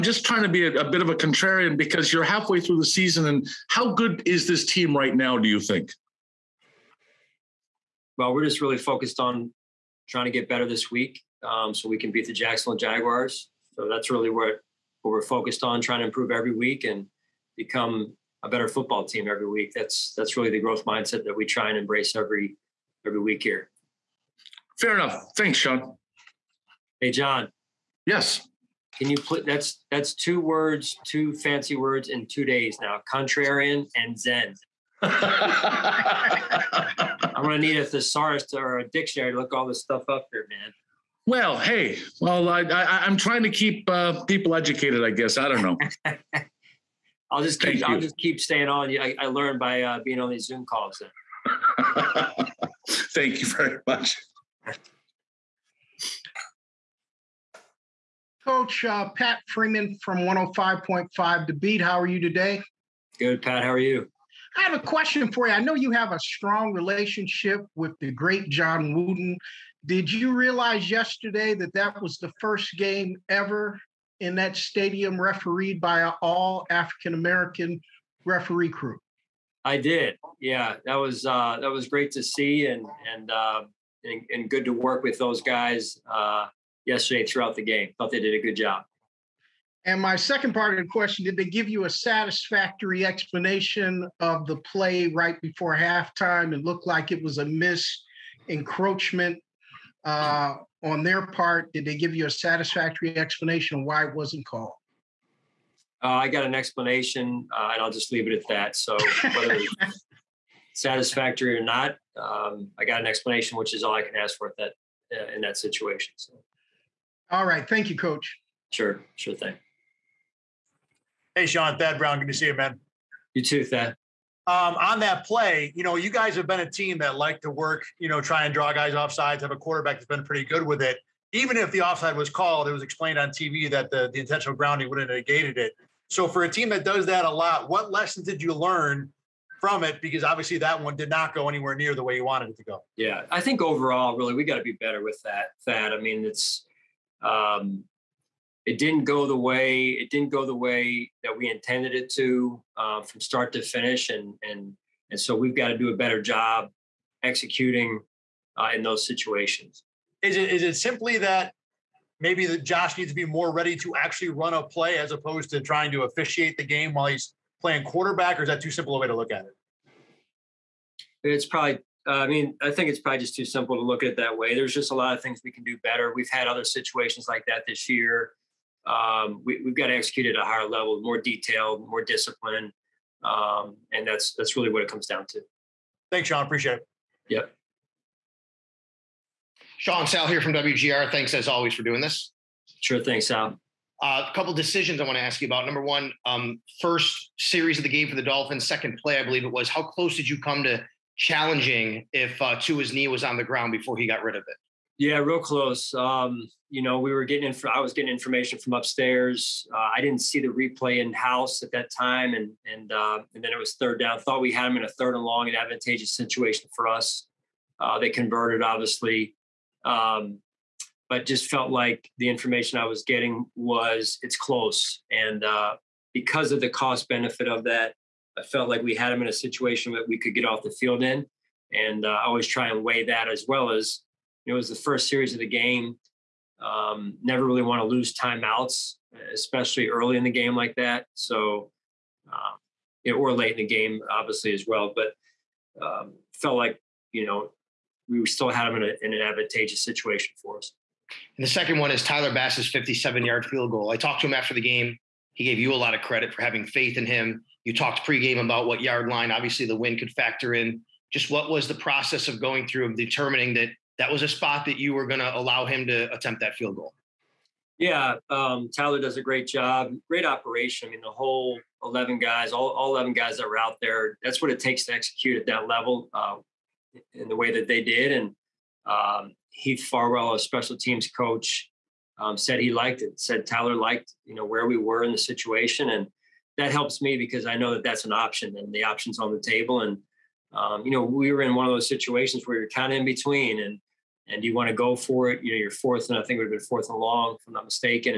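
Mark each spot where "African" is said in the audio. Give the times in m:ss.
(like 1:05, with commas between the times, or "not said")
1:16.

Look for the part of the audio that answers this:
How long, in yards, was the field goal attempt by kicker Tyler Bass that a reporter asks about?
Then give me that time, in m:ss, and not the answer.
4:12.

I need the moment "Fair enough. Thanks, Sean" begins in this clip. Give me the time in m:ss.
0:24.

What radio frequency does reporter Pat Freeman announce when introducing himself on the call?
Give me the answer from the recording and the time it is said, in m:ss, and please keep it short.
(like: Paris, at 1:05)
105.5, at 1:00.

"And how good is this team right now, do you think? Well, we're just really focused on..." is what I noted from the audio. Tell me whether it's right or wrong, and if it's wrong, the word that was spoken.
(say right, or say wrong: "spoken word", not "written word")
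right.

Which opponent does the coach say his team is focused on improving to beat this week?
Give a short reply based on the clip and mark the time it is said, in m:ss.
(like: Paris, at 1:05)
Jacksonville Jaguars, at 0:12.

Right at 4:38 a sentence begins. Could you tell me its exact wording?
And um, Heath Farwell, a special teams coach, um, said he liked it.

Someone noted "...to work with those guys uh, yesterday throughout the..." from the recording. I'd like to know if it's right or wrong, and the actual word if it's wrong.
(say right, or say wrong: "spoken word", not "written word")
right.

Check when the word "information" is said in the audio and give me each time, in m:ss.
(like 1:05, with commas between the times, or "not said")
3:28, 3:42.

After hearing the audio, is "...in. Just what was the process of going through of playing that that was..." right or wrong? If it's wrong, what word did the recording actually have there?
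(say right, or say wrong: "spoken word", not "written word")
wrong: "determining", not "playing".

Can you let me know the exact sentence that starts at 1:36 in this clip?
It looked like it was a miss encroachment uh, on their part.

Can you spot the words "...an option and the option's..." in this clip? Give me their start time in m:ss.
4:48.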